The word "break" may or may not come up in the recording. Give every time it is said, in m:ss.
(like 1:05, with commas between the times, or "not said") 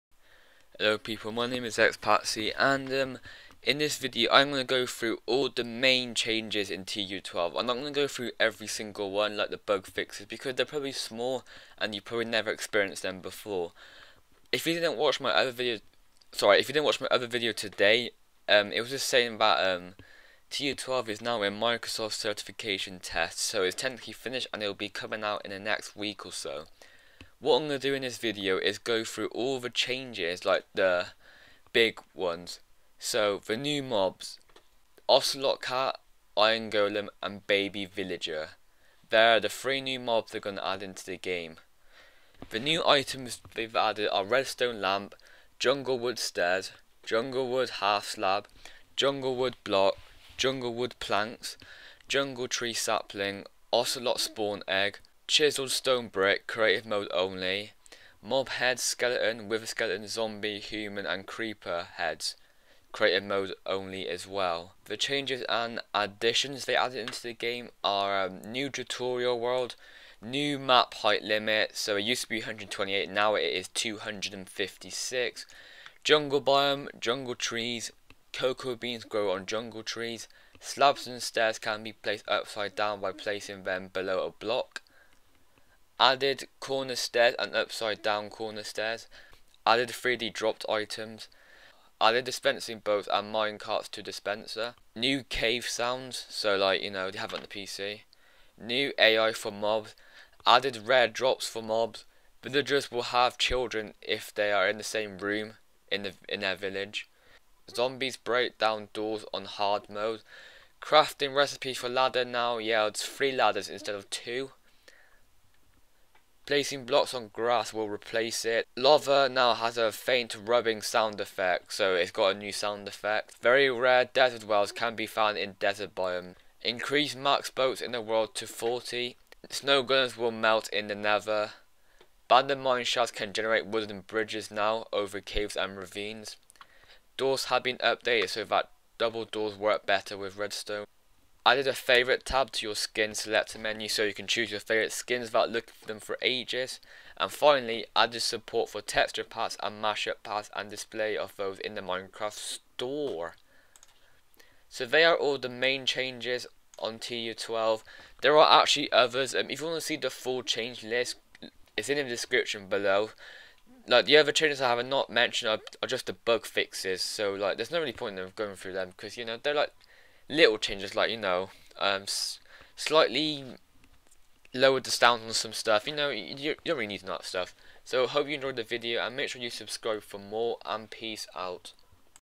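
1:48.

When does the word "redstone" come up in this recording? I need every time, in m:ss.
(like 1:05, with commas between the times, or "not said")
0:44, 2:20.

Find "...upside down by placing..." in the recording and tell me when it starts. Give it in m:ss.
1:22.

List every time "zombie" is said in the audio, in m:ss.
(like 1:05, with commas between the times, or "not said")
1:00, 1:47.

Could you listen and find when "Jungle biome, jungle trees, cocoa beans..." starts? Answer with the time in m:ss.
1:16.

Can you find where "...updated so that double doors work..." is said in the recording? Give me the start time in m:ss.
2:17.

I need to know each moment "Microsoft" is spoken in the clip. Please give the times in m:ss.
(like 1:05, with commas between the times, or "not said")
0:21.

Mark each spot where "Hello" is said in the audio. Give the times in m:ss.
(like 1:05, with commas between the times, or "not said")
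0:00.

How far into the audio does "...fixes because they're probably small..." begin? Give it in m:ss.
0:09.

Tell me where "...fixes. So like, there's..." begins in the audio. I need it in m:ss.
2:46.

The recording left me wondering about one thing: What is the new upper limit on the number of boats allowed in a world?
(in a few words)
40.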